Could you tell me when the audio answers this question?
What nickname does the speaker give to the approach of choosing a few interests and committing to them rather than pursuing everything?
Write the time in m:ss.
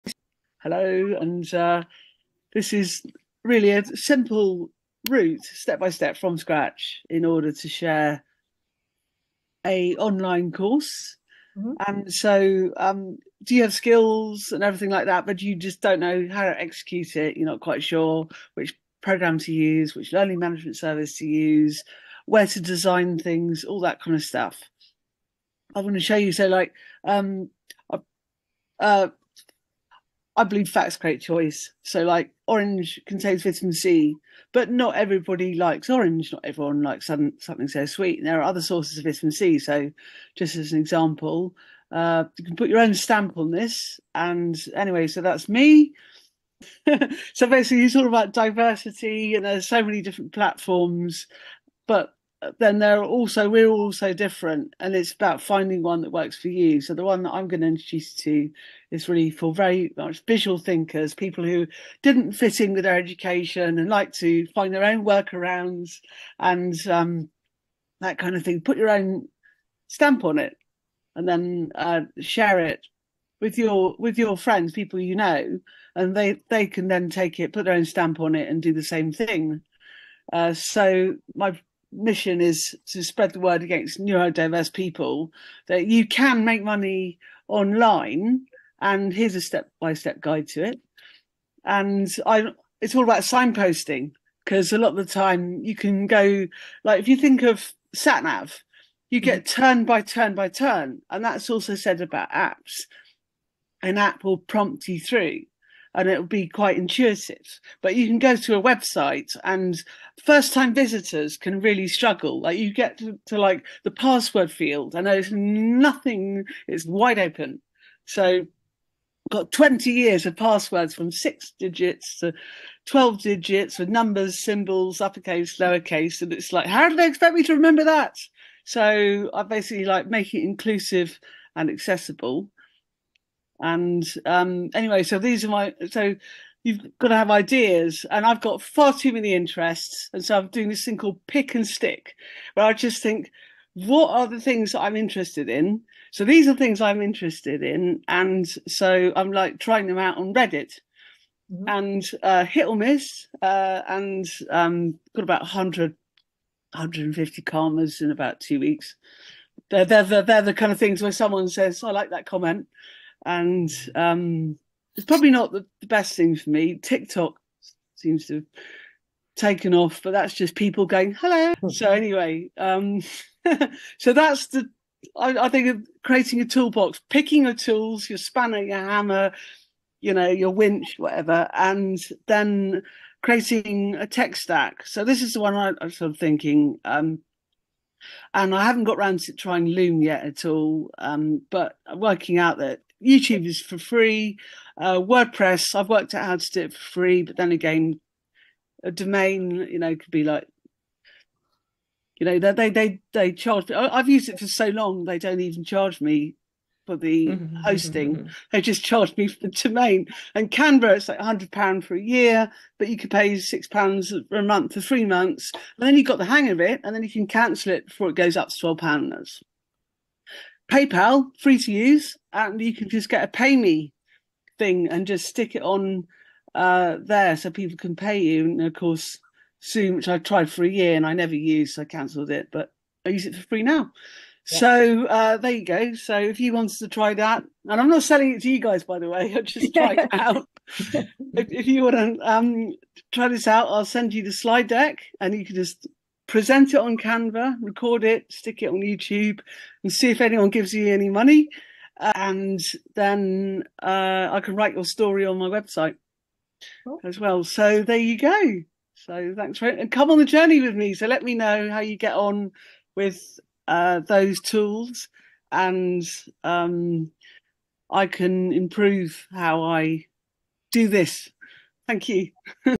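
2:21.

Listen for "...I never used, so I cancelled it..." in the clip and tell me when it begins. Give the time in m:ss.
3:51.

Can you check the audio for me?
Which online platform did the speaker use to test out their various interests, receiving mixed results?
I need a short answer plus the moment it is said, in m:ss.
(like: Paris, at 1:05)
Reddit, at 2:30.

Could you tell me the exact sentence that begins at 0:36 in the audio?
Not everyone likes some, something so sweet.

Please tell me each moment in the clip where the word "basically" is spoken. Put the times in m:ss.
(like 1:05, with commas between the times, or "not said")
0:47, 2:09.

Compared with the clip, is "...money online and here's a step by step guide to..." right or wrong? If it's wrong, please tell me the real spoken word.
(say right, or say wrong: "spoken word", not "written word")
right.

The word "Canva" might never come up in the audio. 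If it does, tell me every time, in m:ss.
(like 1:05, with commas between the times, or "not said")
3:30, 4:06.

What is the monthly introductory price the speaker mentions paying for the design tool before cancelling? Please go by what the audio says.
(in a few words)
6 pounds.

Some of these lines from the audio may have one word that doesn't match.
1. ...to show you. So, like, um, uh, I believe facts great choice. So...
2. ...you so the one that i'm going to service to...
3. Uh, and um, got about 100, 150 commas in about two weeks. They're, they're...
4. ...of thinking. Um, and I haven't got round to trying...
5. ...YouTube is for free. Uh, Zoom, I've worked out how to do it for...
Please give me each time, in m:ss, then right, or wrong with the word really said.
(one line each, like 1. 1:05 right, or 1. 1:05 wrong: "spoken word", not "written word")
1. 0:25 right
2. 0:56 wrong: "introduce", not "service"
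3. 2:33 right
4. 3:06 right
5. 3:13 wrong: "WordPress", not "Zoom".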